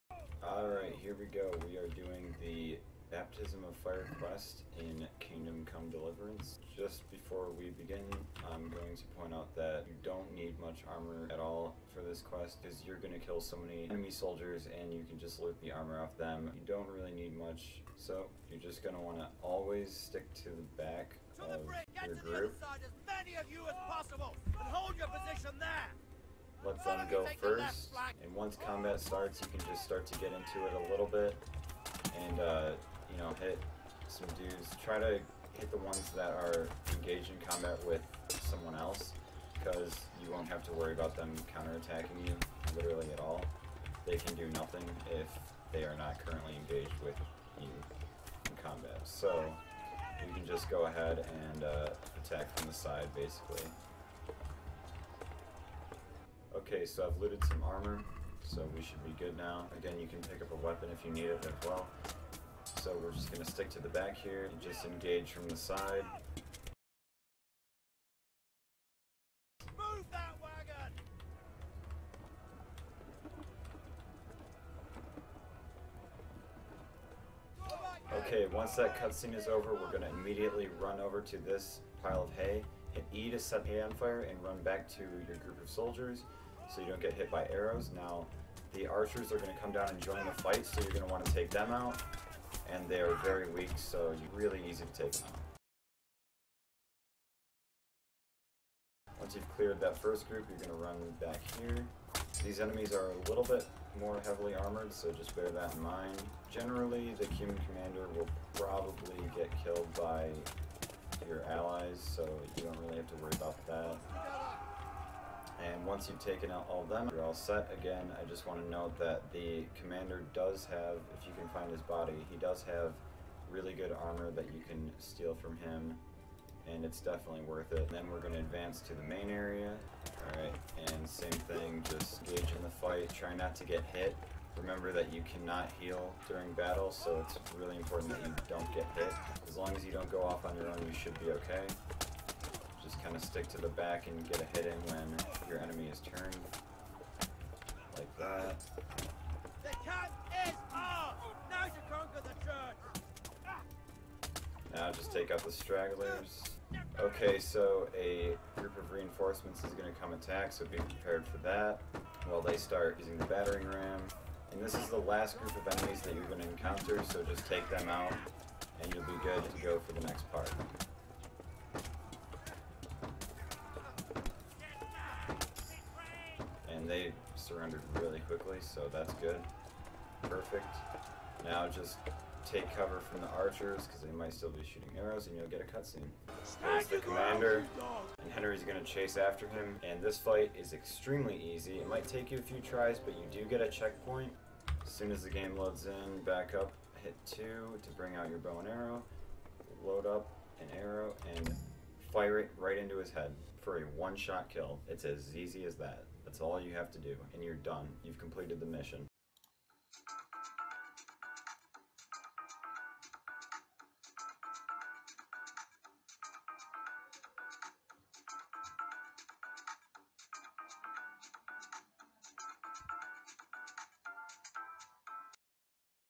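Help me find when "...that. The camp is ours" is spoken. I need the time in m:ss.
2:28.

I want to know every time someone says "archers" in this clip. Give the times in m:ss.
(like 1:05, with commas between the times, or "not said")
1:28, 3:03.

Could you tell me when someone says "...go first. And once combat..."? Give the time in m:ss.
0:27.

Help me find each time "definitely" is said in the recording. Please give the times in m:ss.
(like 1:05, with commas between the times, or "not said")
2:07.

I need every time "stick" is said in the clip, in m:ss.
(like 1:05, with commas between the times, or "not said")
0:19, 1:03, 2:23.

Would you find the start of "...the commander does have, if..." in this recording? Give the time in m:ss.
1:59.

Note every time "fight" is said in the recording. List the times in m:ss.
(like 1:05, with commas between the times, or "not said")
1:30, 2:12, 3:10.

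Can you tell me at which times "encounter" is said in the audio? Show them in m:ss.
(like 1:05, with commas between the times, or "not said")
2:46.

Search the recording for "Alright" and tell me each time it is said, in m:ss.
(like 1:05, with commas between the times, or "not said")
0:00, 2:10.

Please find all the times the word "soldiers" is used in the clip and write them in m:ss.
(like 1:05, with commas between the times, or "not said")
0:14, 1:25.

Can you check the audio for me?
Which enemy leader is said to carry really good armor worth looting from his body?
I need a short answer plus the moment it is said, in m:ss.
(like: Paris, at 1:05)
The Cuman commander, at 1:47.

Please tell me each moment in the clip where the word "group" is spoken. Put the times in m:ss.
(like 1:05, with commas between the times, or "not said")
0:22, 1:25, 1:40, 2:38, 2:45.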